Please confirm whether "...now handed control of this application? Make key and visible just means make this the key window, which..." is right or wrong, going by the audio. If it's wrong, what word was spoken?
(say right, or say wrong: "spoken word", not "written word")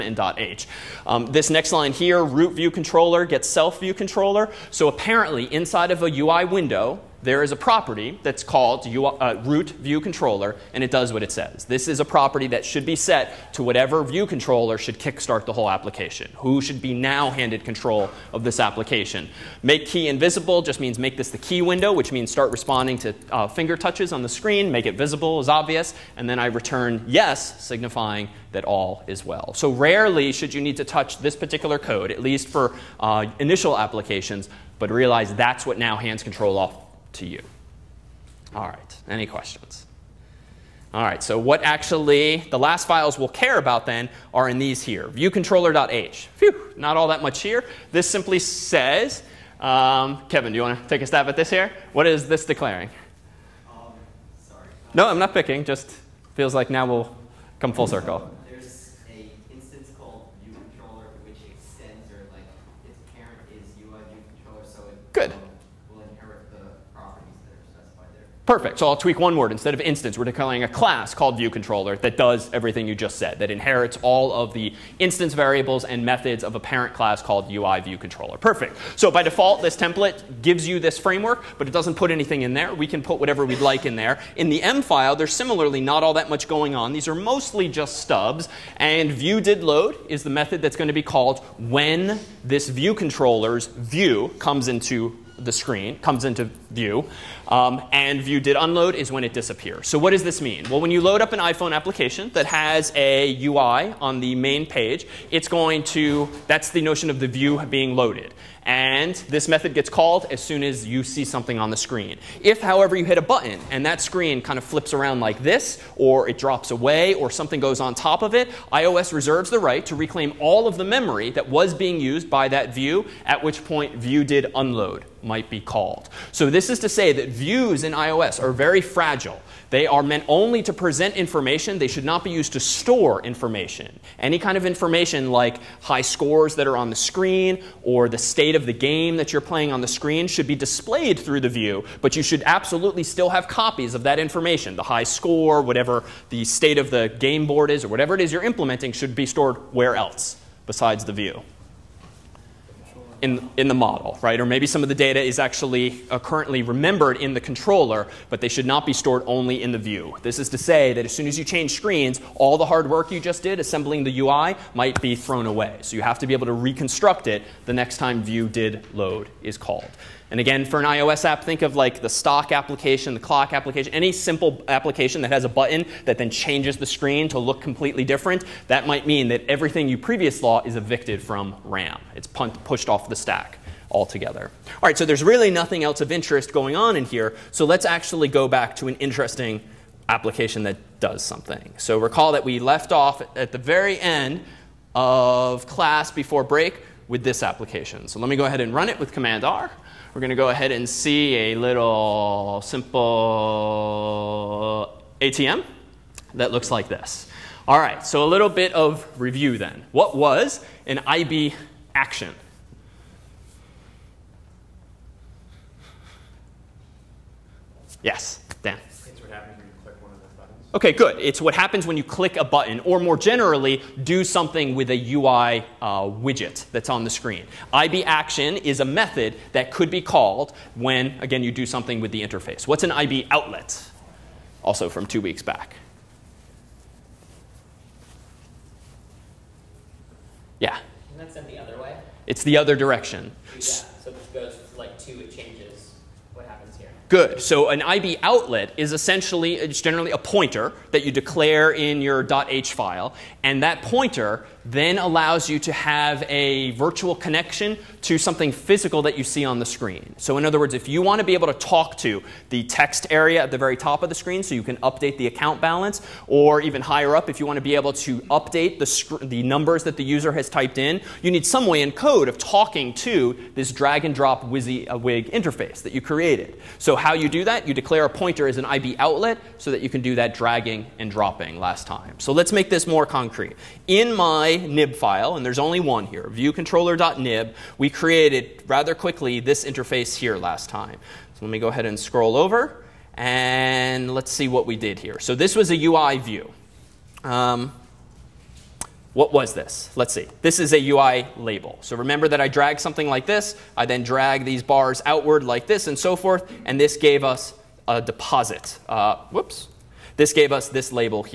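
right.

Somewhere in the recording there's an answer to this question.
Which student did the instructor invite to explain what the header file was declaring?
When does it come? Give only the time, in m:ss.
0:50.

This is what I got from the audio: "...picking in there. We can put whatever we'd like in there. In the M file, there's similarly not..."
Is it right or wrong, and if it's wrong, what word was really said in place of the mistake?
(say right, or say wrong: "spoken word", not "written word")
wrong: "anything", not "picking".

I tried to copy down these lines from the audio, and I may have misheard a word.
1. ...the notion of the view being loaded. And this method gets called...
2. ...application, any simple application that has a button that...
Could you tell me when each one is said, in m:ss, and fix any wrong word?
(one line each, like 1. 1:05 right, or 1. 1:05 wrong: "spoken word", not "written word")
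1. 1:46 right
2. 2:53 right.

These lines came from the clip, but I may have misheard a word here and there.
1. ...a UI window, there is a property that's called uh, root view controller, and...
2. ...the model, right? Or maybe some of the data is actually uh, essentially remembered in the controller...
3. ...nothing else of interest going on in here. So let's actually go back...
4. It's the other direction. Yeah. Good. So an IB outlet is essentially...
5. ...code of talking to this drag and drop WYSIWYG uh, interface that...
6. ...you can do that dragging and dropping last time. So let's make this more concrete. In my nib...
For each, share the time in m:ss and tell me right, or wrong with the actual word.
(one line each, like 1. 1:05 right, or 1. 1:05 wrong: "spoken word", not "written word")
1. 0:06 right
2. 2:33 wrong: "currently", not "essentially"
3. 3:05 right
4. 4:02 right
5. 4:31 right
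6. 4:39 right.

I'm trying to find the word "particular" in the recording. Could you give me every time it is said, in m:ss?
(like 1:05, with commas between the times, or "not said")
0:31.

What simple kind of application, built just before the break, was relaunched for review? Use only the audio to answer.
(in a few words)
ATM.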